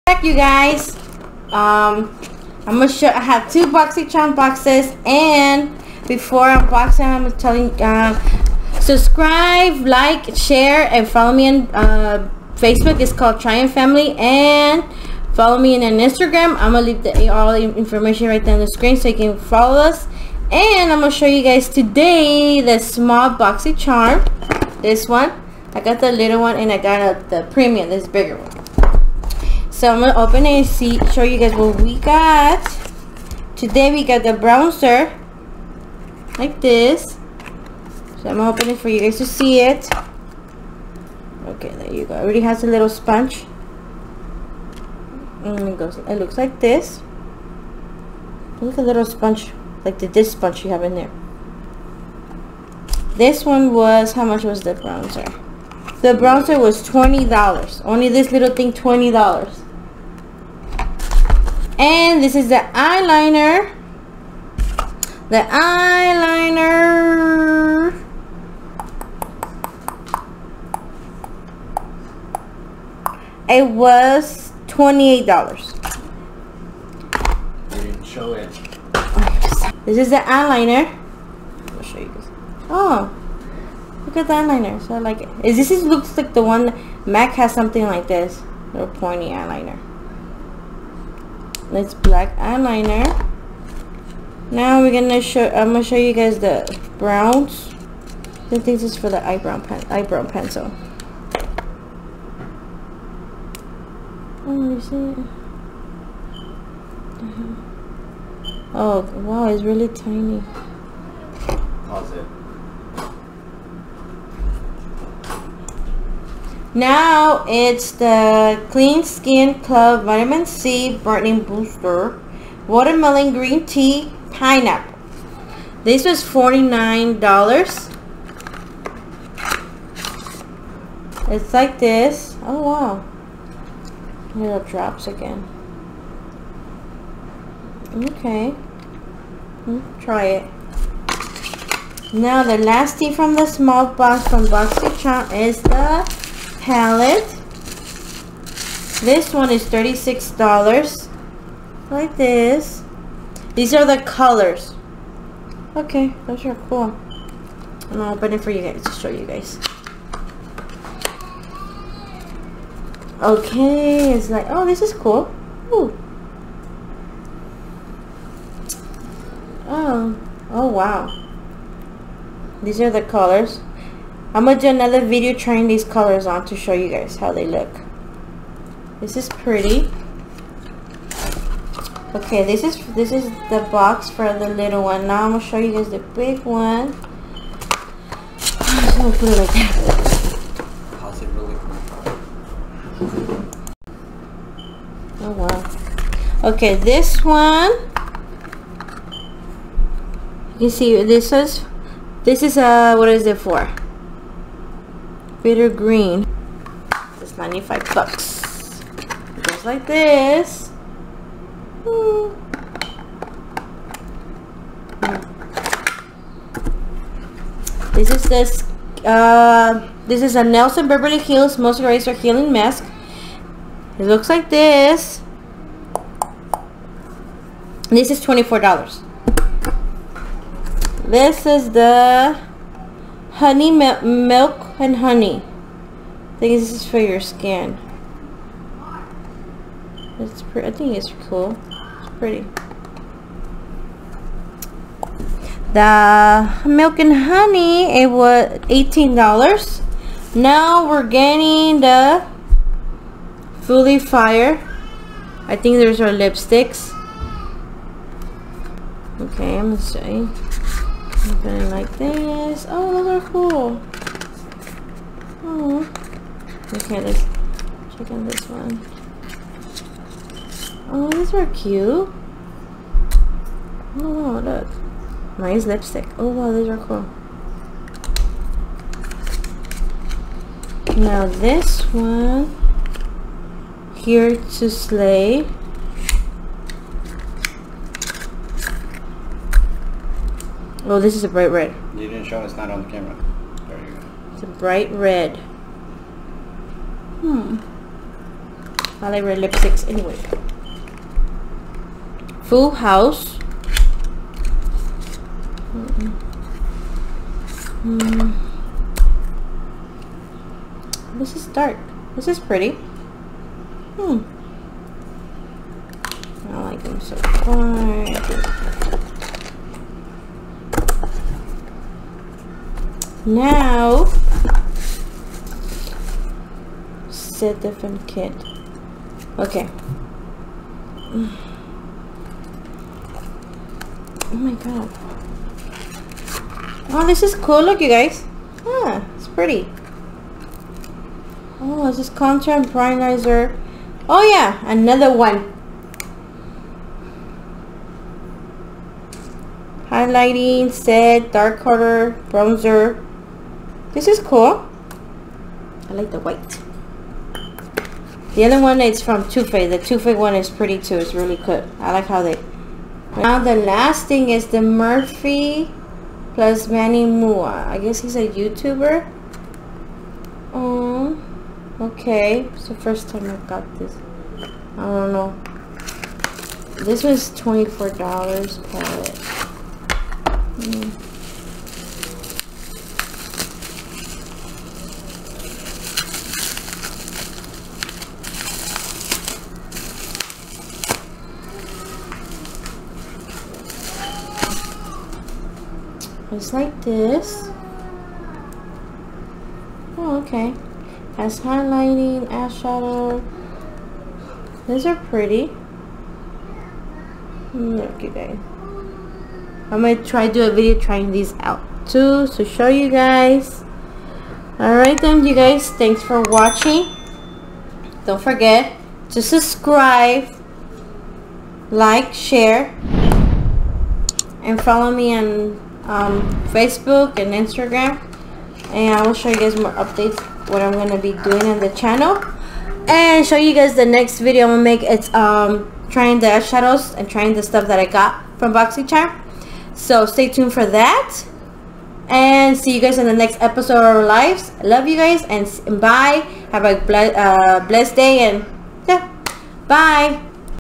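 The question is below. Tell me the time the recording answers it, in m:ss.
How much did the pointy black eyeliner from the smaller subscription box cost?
1:14.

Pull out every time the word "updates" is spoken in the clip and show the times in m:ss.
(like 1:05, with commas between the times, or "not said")
7:09.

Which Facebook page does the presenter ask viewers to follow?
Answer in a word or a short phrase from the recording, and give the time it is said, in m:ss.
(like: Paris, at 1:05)
Tryon Family, at 0:13.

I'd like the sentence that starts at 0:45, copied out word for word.
And it goes, it looks like this.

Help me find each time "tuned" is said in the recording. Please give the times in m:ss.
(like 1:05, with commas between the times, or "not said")
7:20.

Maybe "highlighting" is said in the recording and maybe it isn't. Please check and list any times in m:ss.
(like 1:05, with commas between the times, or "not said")
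5:49, 6:41.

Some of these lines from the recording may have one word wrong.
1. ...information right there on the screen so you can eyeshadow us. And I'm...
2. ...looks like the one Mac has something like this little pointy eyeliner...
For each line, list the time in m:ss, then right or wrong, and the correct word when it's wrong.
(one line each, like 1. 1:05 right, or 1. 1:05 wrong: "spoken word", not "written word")
1. 0:17 wrong: "follow", not "eyeshadow"
2. 1:25 right.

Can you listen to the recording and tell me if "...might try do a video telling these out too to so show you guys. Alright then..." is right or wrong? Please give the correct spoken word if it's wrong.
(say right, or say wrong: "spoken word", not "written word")
wrong: "trying", not "telling".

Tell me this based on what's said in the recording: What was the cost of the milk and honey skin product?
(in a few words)
$18.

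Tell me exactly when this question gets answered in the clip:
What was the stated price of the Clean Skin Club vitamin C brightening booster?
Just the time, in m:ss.
2:06.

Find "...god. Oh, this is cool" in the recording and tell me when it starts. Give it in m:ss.
5:34.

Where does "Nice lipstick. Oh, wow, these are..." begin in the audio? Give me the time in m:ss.
4:35.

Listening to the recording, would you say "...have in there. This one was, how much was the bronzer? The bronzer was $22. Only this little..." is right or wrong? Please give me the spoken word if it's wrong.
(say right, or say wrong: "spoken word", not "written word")
wrong: "20", not "22".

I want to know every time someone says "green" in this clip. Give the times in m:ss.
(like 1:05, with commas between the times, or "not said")
2:03, 3:25.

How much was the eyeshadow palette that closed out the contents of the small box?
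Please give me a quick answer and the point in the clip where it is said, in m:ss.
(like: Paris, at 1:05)
$36, at 2:29.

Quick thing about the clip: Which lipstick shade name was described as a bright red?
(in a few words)
Here to Slay.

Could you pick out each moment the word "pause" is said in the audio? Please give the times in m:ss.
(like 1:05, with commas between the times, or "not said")
1:51.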